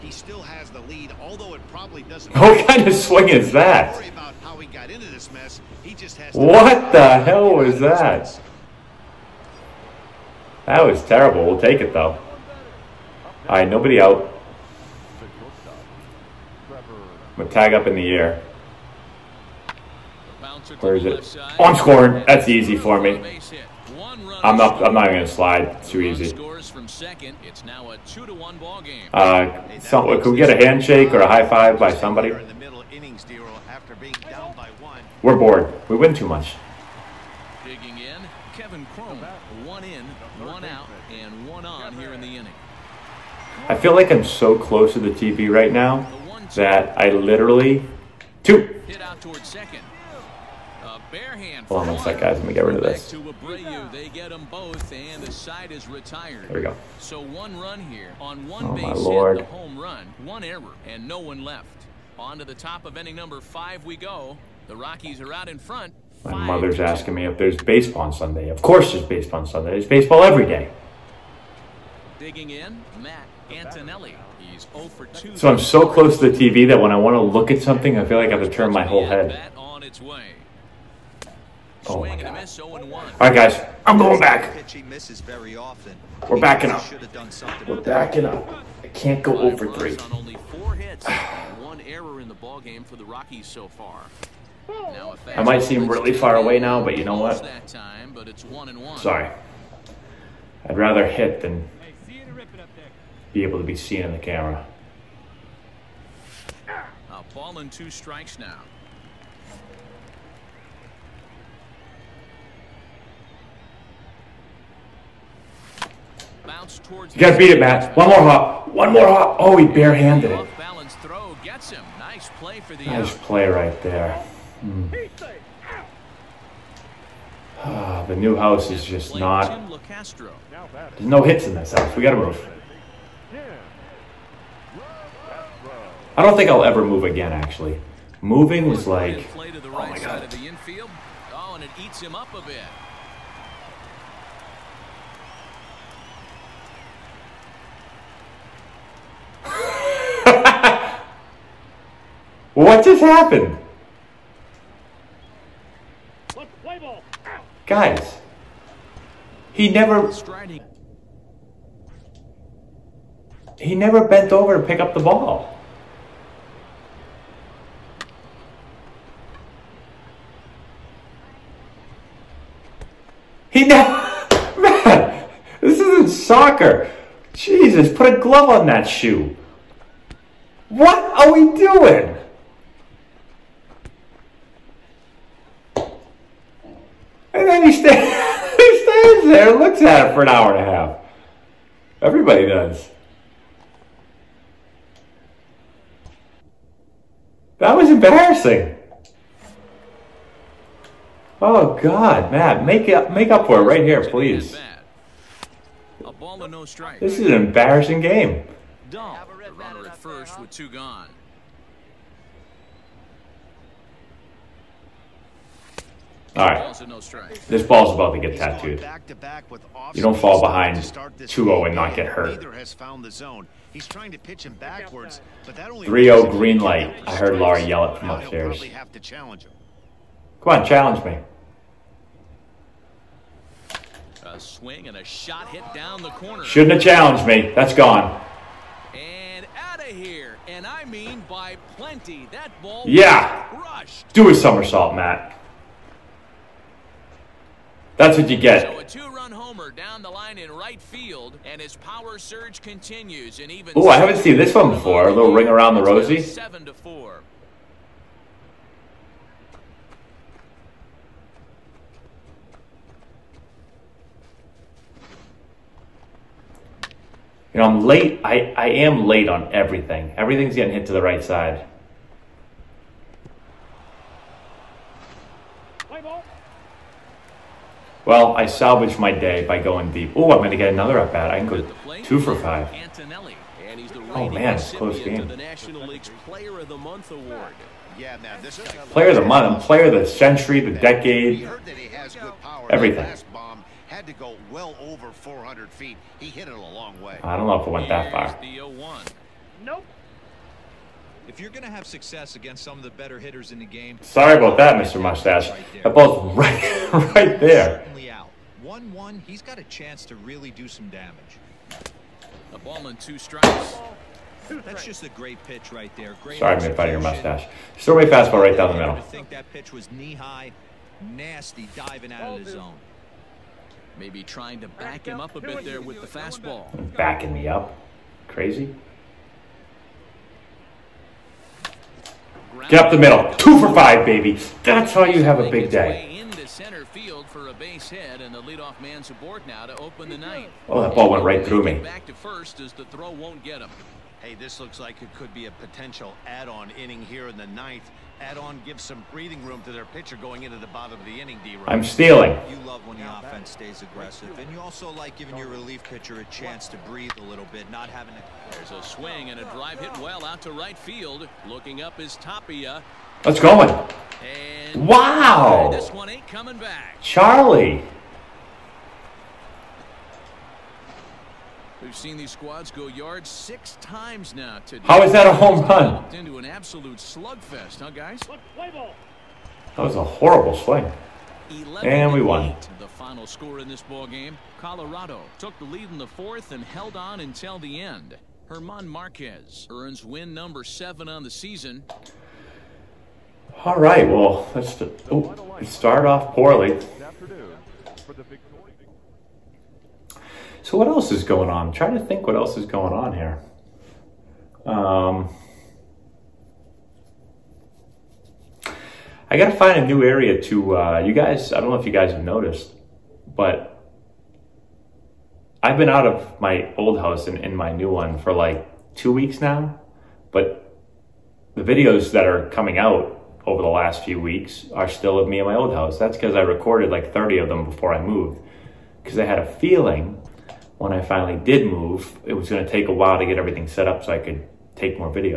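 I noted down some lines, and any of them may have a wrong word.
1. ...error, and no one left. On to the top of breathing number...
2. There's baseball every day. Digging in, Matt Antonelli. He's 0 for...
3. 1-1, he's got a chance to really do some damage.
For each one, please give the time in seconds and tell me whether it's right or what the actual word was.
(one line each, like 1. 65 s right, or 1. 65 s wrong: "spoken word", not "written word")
1. 60 s wrong: "inning", not "breathing"
2. 69 s right
3. 308 s right.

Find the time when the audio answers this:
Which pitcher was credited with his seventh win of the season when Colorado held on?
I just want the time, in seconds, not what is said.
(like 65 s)
388 s.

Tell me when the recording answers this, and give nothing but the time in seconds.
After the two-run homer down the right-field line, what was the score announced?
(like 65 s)
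256 s.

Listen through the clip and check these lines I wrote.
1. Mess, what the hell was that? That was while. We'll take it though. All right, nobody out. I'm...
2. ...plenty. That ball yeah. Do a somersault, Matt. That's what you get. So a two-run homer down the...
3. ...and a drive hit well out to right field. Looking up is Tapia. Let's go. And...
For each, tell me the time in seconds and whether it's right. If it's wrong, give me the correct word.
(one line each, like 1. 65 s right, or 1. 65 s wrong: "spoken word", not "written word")
1. 5 s wrong: "terrible", not "while"
2. 241 s right
3. 359 s right.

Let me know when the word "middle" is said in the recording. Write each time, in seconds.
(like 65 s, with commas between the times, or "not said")
318 s, 332 s.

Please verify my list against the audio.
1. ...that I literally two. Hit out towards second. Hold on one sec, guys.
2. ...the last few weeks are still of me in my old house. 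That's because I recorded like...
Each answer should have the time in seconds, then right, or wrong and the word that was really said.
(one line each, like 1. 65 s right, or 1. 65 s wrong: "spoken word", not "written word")
1. 46 s right
2. 423 s right.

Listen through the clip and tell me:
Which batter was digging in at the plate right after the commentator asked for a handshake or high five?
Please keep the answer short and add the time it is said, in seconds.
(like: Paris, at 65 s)
Kevin Cron, at 38 s.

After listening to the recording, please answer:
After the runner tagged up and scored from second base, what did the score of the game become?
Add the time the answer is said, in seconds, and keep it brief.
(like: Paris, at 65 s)
2 to 1, at 28 s.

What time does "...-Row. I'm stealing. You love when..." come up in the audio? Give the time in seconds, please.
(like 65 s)
351 s.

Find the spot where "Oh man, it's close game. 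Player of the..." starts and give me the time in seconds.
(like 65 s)
284 s.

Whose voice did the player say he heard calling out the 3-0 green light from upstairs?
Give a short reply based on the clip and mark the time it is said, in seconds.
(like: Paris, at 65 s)
Laura, at 227 s.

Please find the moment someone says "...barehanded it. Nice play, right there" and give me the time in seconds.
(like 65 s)
119 s.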